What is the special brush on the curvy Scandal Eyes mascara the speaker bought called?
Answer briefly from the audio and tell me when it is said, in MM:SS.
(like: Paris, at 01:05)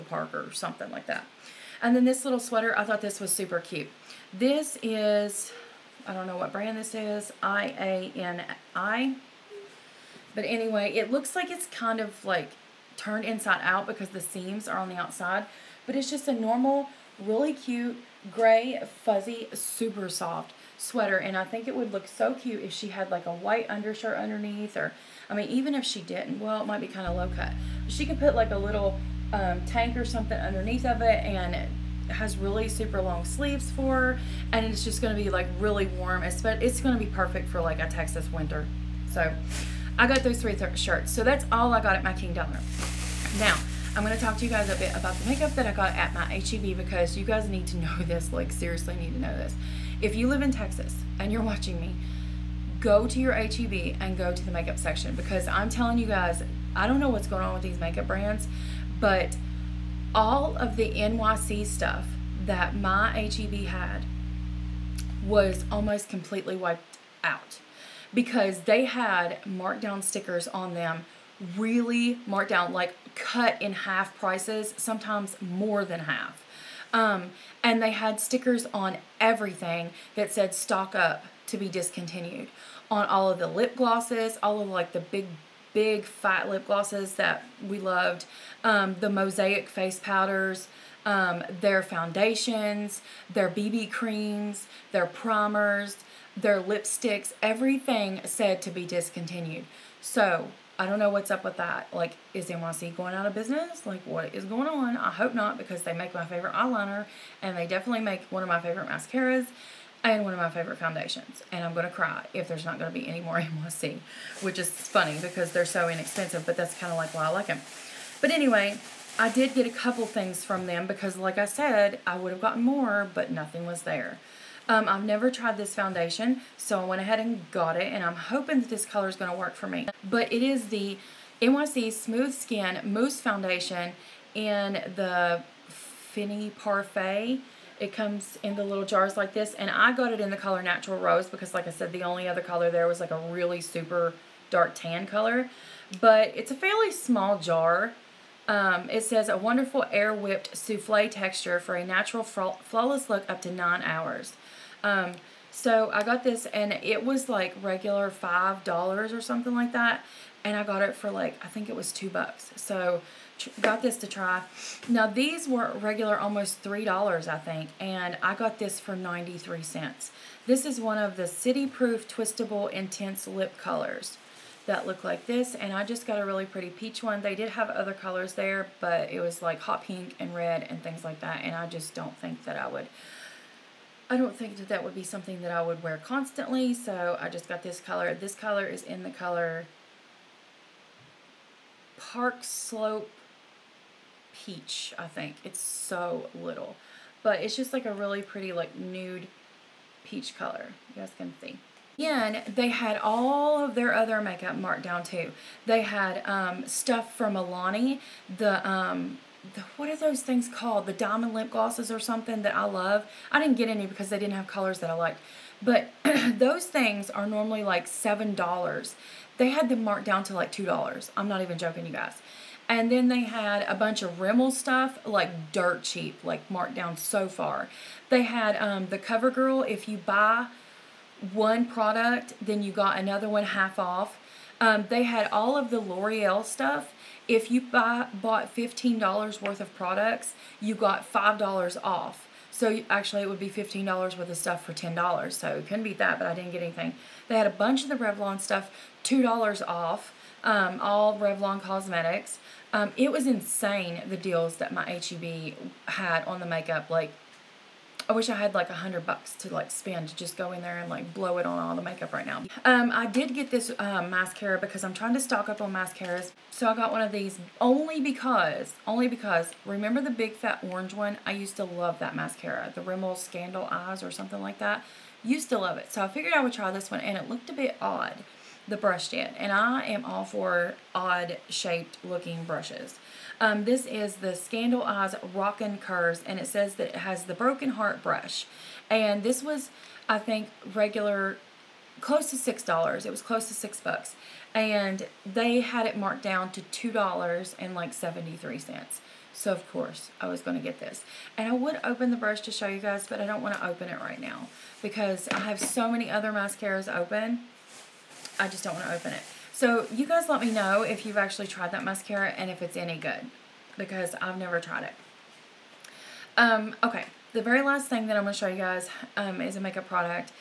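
Broken Heart brush, at 04:47.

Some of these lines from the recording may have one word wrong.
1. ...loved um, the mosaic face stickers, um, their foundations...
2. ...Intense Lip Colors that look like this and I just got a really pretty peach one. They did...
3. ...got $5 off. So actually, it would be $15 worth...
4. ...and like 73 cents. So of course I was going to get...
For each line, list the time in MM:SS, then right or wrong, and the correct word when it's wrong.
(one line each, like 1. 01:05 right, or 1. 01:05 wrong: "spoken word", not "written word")
1. 01:27 wrong: "powders", not "stickers"
2. 02:52 right
3. 04:00 right
4. 04:57 right.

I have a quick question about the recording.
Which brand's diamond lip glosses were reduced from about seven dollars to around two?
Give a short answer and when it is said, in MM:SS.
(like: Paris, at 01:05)
Milani, at 03:27.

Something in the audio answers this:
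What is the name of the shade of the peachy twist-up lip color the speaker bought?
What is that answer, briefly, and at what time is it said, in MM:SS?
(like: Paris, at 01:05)
Park Slope Peach, at 03:11.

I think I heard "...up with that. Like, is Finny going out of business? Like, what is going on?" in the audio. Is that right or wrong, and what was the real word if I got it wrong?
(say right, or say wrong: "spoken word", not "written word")
wrong: "NYC", not "Finny".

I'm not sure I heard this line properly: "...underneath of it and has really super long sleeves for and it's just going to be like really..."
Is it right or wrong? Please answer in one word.
right.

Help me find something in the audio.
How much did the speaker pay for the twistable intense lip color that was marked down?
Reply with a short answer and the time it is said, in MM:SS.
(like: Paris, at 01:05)
93 cents, at 02:48.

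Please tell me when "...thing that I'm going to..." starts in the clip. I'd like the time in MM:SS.
05:17.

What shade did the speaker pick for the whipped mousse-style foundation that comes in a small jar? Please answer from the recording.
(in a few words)
Natural Rose.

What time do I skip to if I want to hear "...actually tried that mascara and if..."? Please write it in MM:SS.
05:11.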